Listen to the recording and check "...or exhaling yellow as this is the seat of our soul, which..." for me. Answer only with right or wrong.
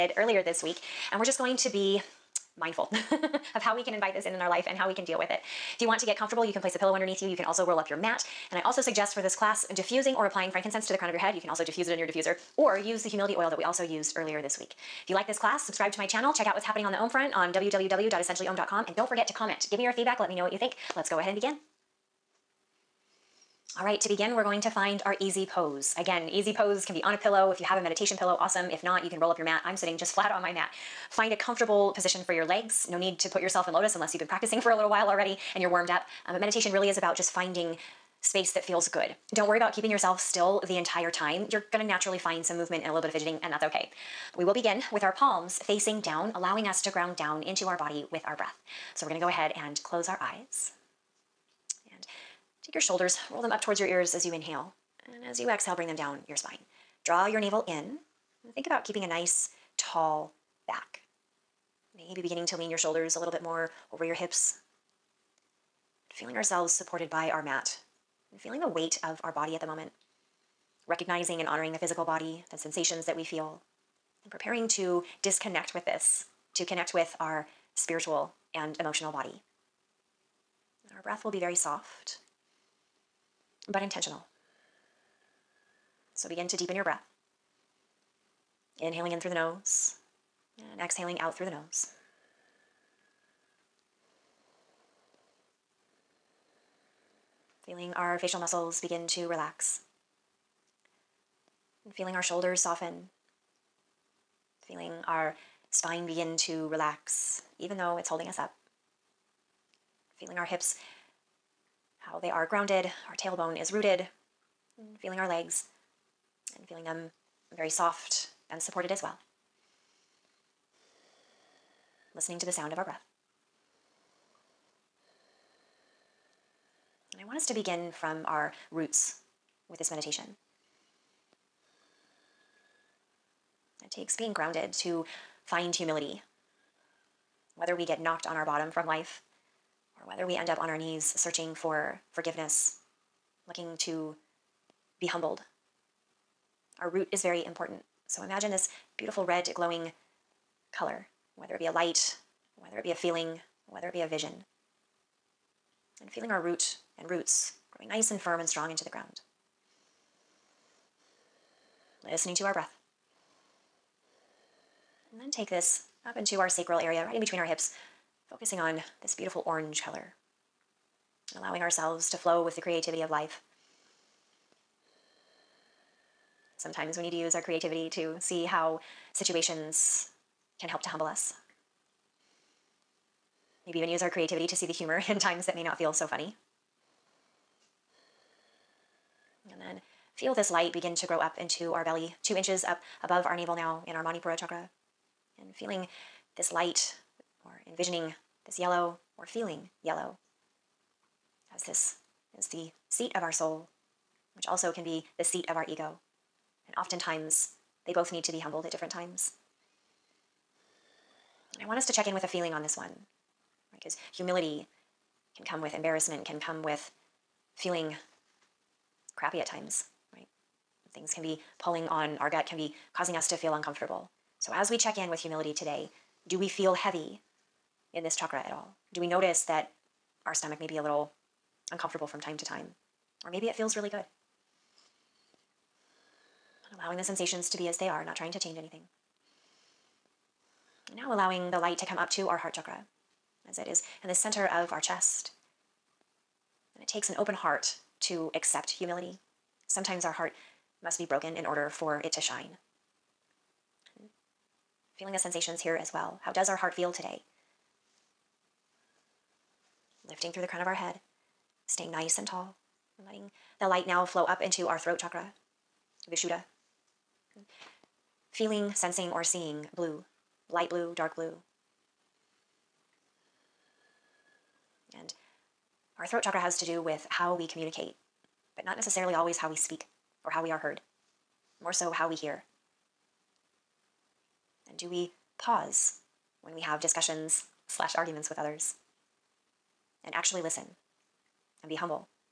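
wrong.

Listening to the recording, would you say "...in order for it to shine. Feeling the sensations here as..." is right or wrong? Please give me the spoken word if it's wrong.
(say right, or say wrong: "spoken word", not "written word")
right.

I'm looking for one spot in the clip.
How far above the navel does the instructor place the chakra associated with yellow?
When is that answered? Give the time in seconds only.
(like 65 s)
192 s.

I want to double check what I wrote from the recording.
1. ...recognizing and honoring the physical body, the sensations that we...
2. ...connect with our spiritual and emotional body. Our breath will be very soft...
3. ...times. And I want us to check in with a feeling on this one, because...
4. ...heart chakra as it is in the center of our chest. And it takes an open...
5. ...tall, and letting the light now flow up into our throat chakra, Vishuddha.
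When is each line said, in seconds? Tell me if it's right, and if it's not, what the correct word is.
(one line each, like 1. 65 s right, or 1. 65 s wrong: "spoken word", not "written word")
1. 70 s right
2. 76 s right
3. 208 s right
4. 242 s right
5. 262 s right.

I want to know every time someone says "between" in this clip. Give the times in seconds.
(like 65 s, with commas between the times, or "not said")
167 s.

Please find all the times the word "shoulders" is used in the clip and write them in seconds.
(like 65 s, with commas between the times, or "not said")
52 s, 62 s, 102 s.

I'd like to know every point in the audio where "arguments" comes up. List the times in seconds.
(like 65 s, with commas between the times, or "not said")
287 s.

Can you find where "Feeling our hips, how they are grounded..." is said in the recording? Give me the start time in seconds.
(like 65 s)
110 s.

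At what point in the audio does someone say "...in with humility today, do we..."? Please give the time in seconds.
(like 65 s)
224 s.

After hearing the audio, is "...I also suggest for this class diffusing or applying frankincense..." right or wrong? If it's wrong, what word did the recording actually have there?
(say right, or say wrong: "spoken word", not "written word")
right.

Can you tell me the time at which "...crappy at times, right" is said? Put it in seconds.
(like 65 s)
219 s.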